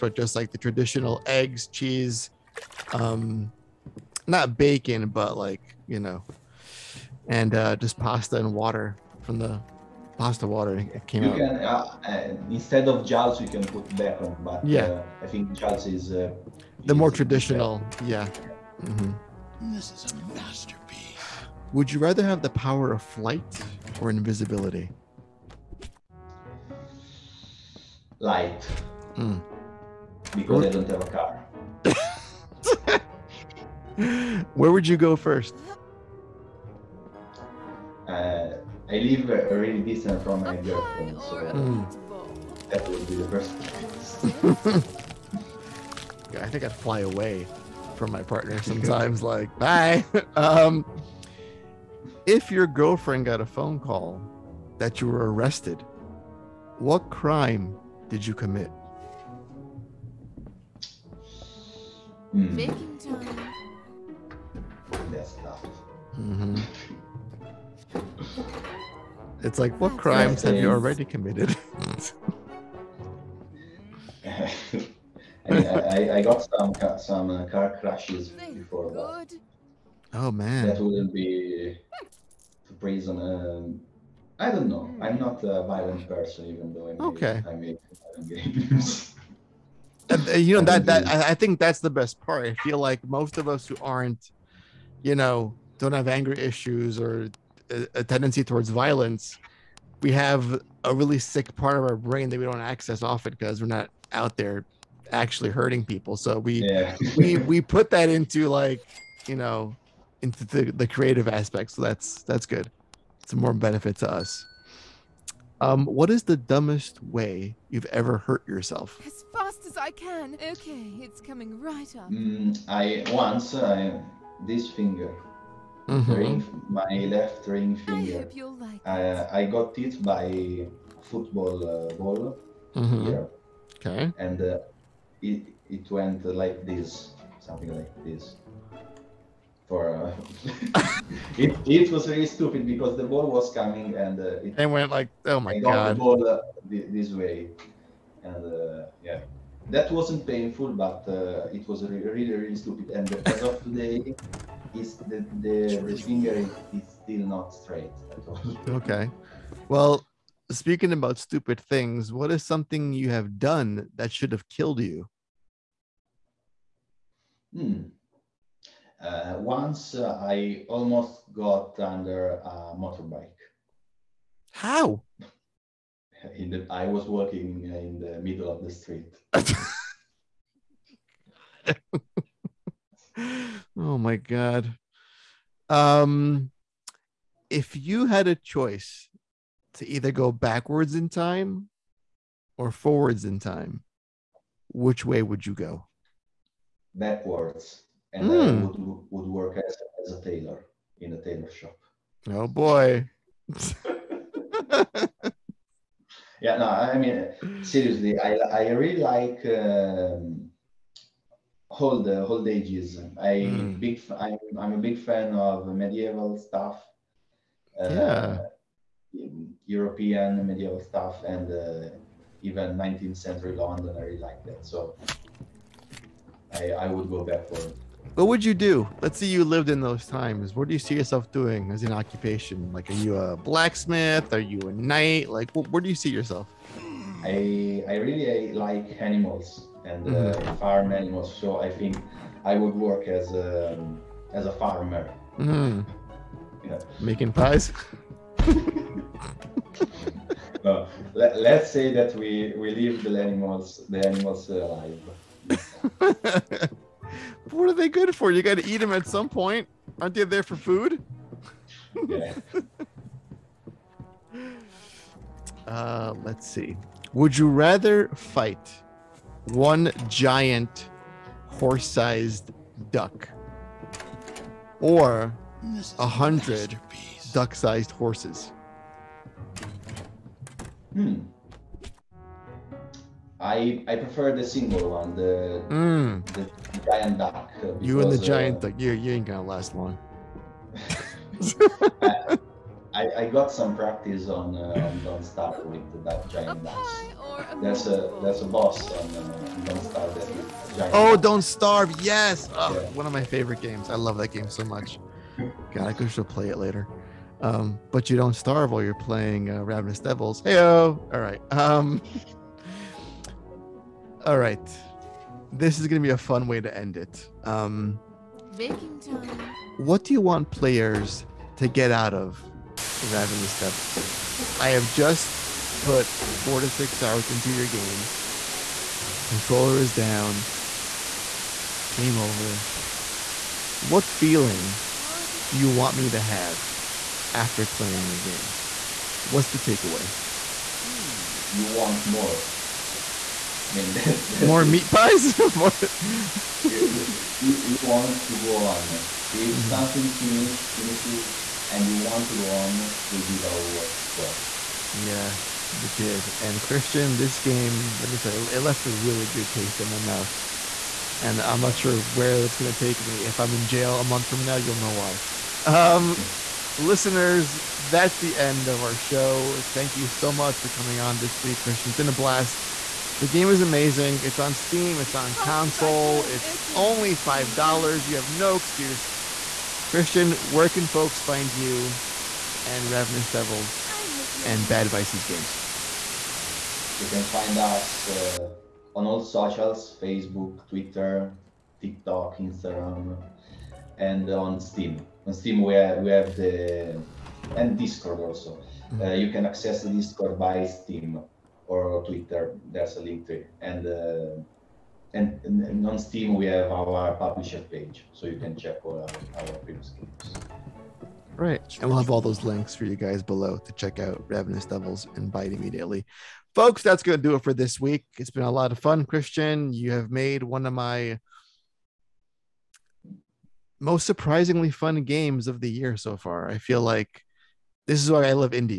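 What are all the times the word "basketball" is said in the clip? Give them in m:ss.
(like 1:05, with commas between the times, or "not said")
not said.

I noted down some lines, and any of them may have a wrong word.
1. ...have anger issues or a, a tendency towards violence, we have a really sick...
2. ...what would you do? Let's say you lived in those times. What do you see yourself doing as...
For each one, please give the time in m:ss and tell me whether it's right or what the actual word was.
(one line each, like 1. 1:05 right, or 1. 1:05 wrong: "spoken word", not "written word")
1. 1:35 right
2. 3:48 right.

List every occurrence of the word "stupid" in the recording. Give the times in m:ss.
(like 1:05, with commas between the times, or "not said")
2:22, 2:32, 2:41.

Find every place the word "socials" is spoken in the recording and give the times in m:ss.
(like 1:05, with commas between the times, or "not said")
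6:29.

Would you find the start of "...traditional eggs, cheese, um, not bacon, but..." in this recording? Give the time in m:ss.
0:00.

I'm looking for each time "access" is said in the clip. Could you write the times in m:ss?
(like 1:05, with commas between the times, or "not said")
1:42, 6:39.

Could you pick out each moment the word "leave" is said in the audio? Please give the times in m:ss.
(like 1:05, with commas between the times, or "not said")
4:12.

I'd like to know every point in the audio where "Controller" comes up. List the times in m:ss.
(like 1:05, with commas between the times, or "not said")
5:29.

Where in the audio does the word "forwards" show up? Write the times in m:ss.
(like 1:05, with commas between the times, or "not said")
3:12.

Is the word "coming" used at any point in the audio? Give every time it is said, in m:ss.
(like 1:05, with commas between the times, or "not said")
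2:01, 2:23, 6:10.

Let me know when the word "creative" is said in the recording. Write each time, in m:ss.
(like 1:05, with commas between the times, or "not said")
1:50.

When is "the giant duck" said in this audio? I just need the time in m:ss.
4:46.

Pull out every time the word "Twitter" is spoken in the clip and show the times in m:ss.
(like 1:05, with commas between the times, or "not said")
6:30, 6:42.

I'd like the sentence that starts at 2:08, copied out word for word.
I, like uh, I got it by football uh, ball mm-hmm.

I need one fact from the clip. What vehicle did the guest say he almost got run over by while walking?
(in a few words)
Motorbike.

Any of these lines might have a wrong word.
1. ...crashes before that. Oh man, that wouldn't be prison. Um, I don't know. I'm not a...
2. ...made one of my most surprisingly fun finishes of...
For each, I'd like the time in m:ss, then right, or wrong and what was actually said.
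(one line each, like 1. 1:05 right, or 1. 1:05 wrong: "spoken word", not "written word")
1. 1:17 right
2. 7:00 wrong: "games", not "finishes".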